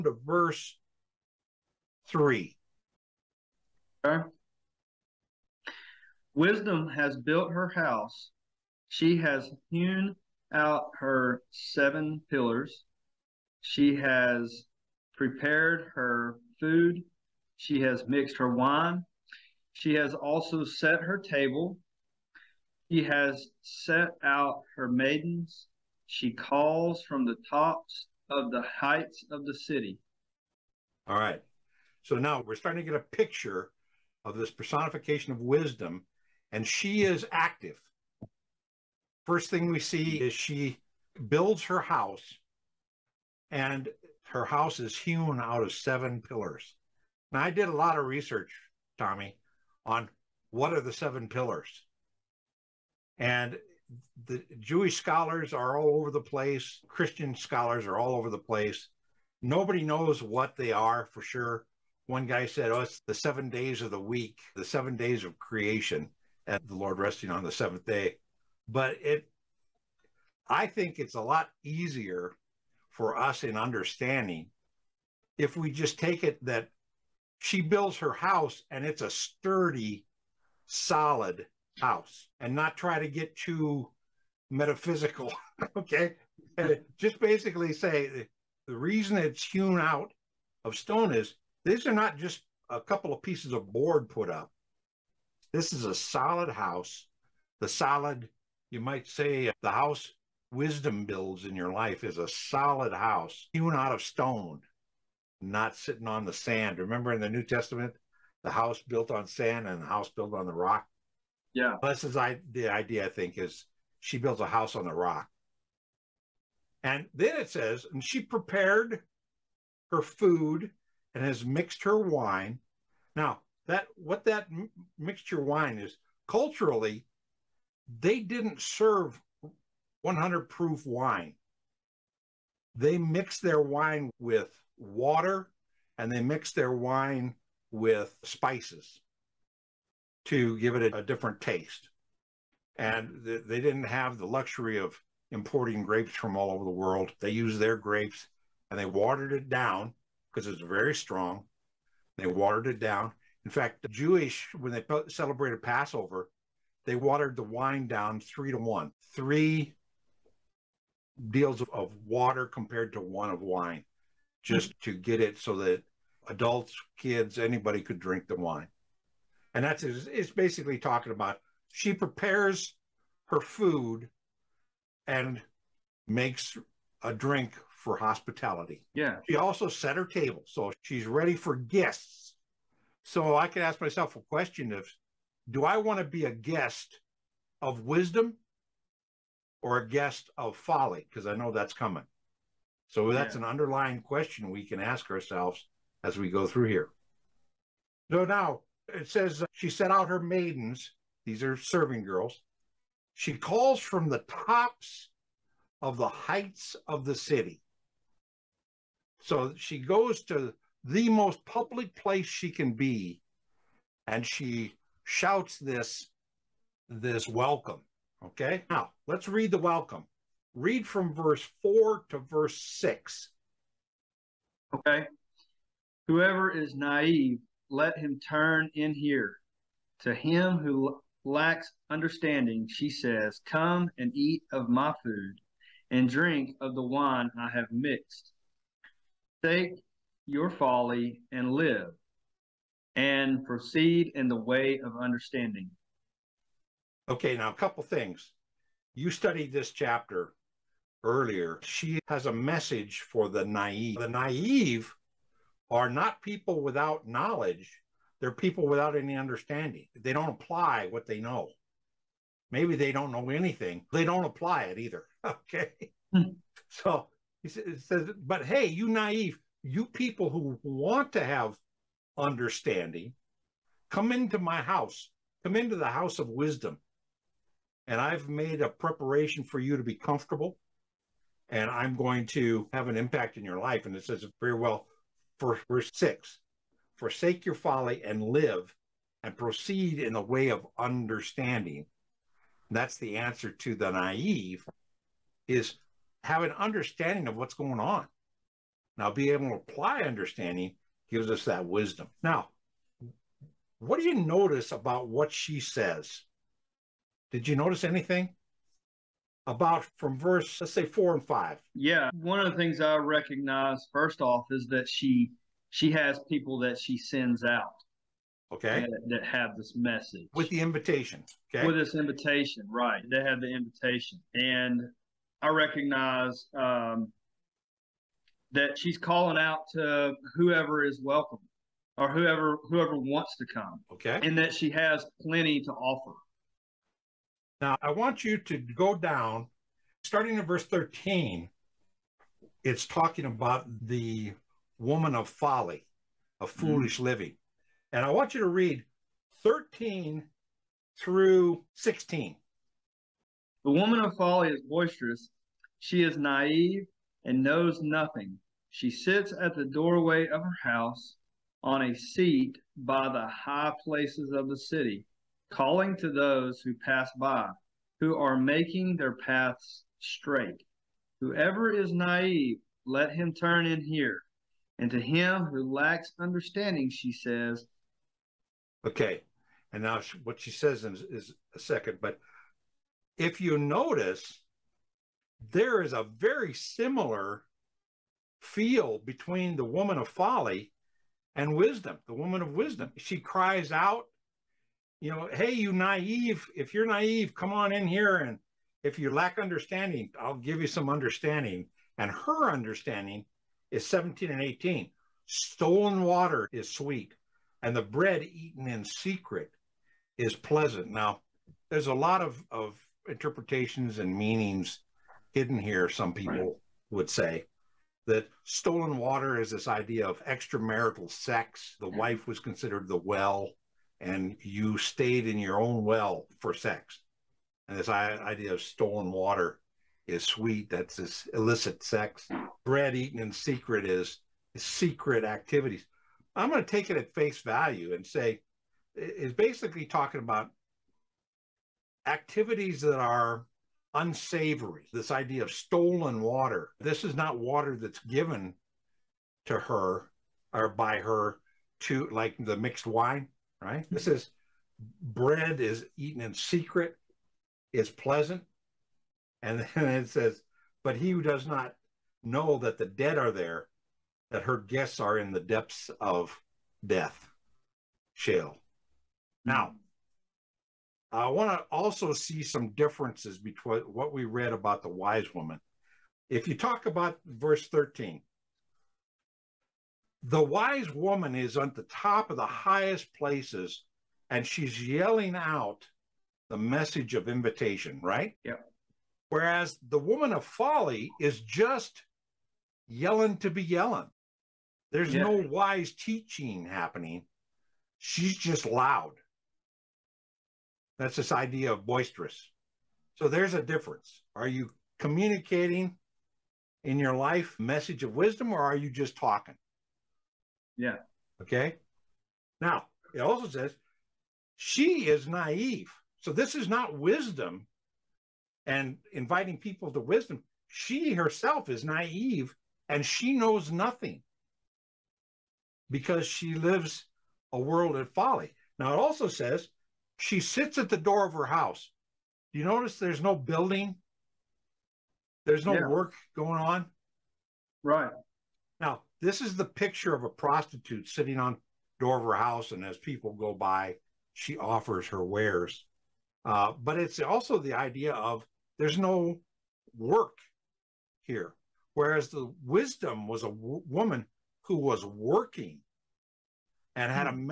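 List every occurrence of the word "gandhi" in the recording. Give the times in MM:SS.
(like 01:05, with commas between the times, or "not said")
not said.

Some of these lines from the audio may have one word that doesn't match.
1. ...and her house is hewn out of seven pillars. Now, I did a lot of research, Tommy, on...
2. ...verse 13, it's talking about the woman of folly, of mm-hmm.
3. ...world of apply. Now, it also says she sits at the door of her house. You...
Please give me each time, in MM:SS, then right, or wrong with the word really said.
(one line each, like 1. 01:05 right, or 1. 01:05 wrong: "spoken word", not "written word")
1. 00:43 right
2. 05:40 right
3. 08:47 wrong: "folly", not "apply".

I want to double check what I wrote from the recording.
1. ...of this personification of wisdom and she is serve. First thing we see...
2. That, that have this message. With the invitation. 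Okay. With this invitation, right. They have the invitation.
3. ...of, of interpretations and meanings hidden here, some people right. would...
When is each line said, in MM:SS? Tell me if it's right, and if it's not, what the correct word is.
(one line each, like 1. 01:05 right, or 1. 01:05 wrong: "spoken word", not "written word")
1. 00:34 wrong: "active", not "serve"
2. 05:18 right
3. 06:52 right.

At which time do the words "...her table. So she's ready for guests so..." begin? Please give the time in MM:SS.
02:59.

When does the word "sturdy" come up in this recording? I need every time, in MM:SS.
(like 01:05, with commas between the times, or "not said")
01:19.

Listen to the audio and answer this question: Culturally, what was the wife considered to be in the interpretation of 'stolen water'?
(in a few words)
the well.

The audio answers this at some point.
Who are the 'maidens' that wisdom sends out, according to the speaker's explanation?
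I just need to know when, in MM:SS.
03:21.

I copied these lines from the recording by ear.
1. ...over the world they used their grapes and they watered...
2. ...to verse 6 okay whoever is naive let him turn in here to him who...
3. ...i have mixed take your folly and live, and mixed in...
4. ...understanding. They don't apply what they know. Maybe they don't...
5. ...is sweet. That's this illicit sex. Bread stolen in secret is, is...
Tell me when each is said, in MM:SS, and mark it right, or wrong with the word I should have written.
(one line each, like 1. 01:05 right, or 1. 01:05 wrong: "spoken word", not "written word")
1. 02:26 right
2. 03:42 right
3. 03:57 wrong: "proceed", not "mixed"
4. 04:19 right
5. 07:10 wrong: "eaten", not "stolen".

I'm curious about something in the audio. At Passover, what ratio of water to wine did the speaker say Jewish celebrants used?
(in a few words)
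3 to 1.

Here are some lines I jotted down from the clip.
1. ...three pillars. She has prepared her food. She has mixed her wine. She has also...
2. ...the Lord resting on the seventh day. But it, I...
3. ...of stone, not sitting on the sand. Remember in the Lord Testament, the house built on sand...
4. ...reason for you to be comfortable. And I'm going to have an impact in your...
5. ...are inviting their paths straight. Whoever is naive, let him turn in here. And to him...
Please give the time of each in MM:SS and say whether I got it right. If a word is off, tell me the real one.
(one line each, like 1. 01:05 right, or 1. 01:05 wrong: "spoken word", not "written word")
1. 00:11 wrong: "seven", not "three"
2. 01:06 right
3. 01:43 wrong: "New", not "Lord"
4. 04:38 wrong: "preparation", not "reason"
5. 06:08 wrong: "making", not "inviting".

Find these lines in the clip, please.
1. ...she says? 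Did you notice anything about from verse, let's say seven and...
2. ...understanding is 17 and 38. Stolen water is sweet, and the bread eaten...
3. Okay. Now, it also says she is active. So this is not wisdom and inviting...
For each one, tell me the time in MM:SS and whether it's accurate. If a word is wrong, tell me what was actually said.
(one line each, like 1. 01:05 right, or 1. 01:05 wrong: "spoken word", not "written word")
1. 05:05 wrong: "four", not "seven"
2. 06:42 wrong: "18", not "38"
3. 08:31 wrong: "naive", not "active".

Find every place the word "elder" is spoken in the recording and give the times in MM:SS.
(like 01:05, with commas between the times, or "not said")
not said.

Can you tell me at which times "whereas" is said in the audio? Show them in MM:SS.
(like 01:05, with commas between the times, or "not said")
08:09, 09:11.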